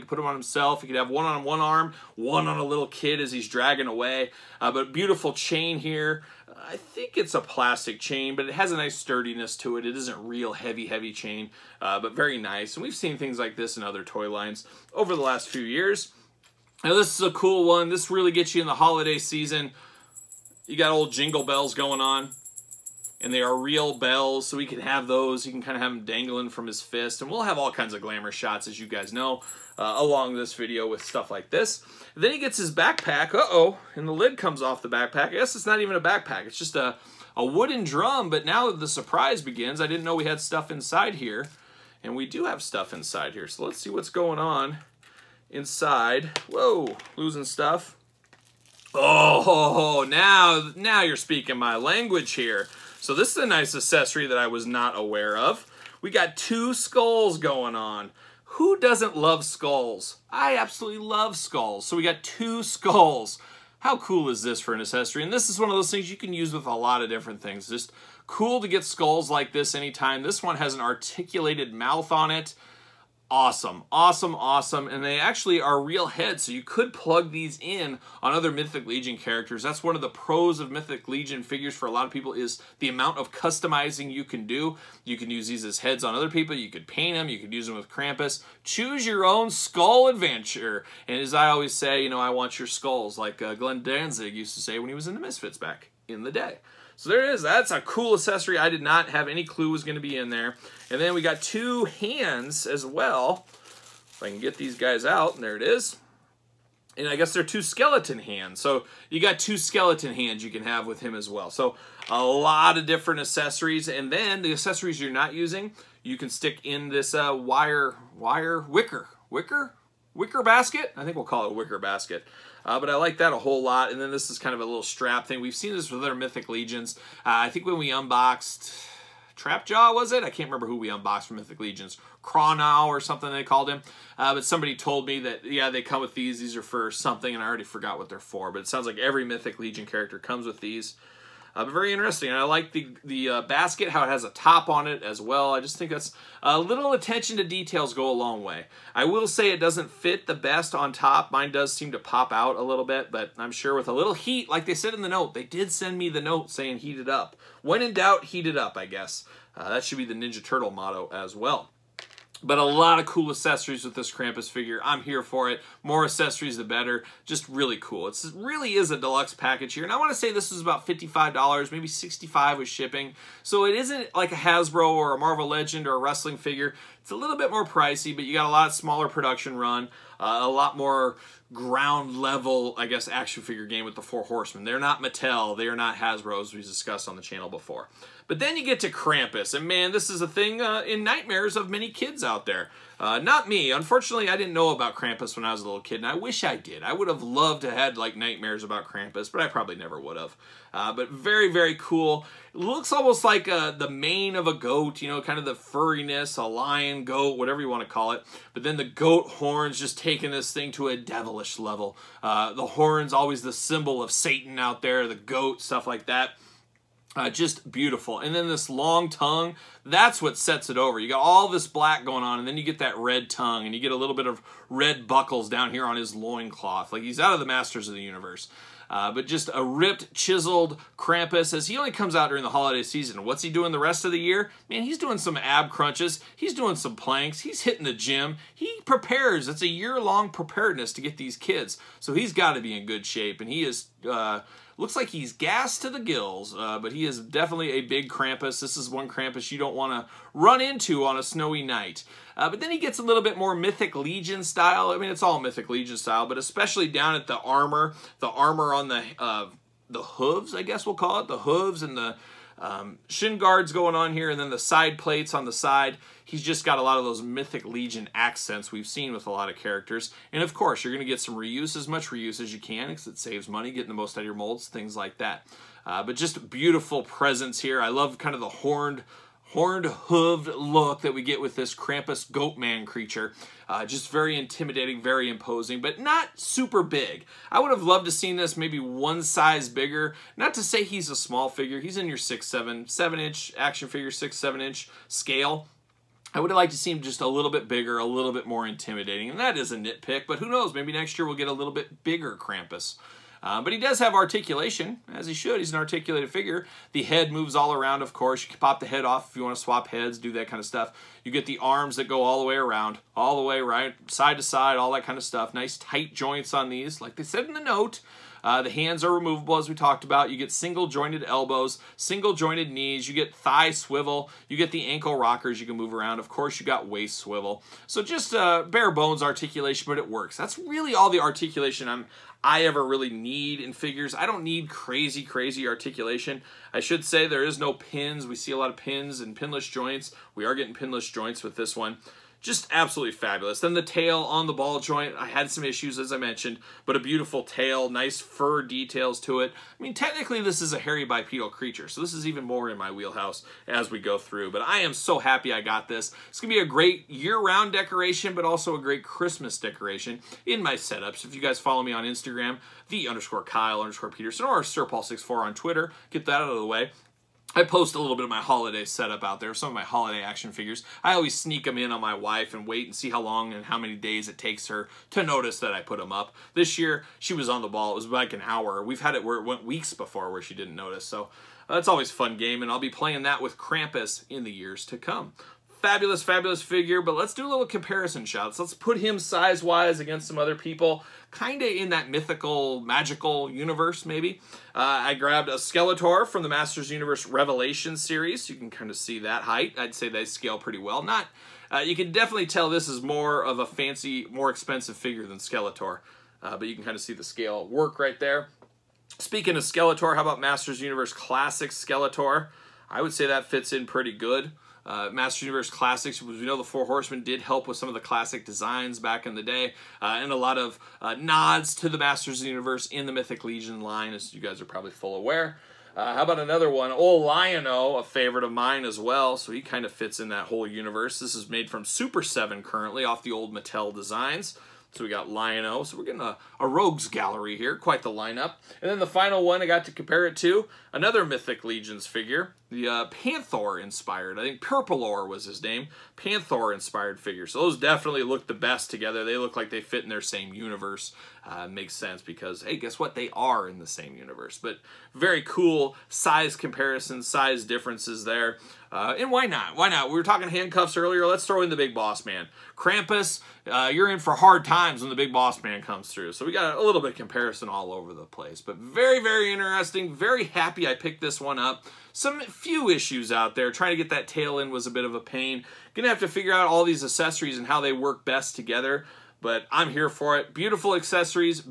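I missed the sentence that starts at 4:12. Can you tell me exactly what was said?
Uh, but then he gets a little bit more Mythic Legion style.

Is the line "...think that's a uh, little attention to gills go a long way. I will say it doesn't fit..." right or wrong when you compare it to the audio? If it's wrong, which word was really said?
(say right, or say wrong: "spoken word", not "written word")
wrong: "details", not "gills".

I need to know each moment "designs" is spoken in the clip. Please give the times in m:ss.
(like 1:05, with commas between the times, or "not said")
6:58, 7:13.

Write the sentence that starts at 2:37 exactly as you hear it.
When in doubt, heat it up, I guess.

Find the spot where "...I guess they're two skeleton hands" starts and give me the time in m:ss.
1:47.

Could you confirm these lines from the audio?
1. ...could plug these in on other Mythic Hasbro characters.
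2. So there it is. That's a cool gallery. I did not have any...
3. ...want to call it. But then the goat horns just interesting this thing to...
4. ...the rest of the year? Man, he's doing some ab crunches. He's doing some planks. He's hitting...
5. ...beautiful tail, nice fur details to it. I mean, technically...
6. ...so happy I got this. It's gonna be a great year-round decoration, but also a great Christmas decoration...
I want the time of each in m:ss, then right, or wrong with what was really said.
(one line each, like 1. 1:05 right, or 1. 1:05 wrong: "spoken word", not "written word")
1. 1:16 wrong: "Legion", not "Hasbro"
2. 1:36 wrong: "accessory", not "gallery"
3. 3:27 wrong: "taking", not "interesting"
4. 3:53 right
5. 5:46 right
6. 5:54 right.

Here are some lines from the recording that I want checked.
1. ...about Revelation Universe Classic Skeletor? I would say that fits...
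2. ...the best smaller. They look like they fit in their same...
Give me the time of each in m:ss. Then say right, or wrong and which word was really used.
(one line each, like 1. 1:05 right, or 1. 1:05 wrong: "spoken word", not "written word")
1. 6:50 wrong: "Masters", not "Revelation"
2. 7:28 wrong: "together", not "smaller".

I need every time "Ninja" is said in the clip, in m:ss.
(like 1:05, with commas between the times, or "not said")
2:40.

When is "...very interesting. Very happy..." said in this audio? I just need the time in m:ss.
7:49.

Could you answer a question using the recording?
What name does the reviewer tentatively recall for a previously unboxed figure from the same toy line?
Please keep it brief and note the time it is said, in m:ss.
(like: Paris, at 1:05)
Cronow, at 2:12.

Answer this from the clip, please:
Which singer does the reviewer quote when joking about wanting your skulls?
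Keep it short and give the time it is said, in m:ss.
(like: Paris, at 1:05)
Glenn Danzig, at 1:33.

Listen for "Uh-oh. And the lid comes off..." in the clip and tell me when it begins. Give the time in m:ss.
0:33.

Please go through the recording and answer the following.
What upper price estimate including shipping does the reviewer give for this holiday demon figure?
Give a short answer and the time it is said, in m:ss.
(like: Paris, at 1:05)
$65, at 2:51.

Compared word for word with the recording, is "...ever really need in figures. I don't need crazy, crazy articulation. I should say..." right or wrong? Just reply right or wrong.
right.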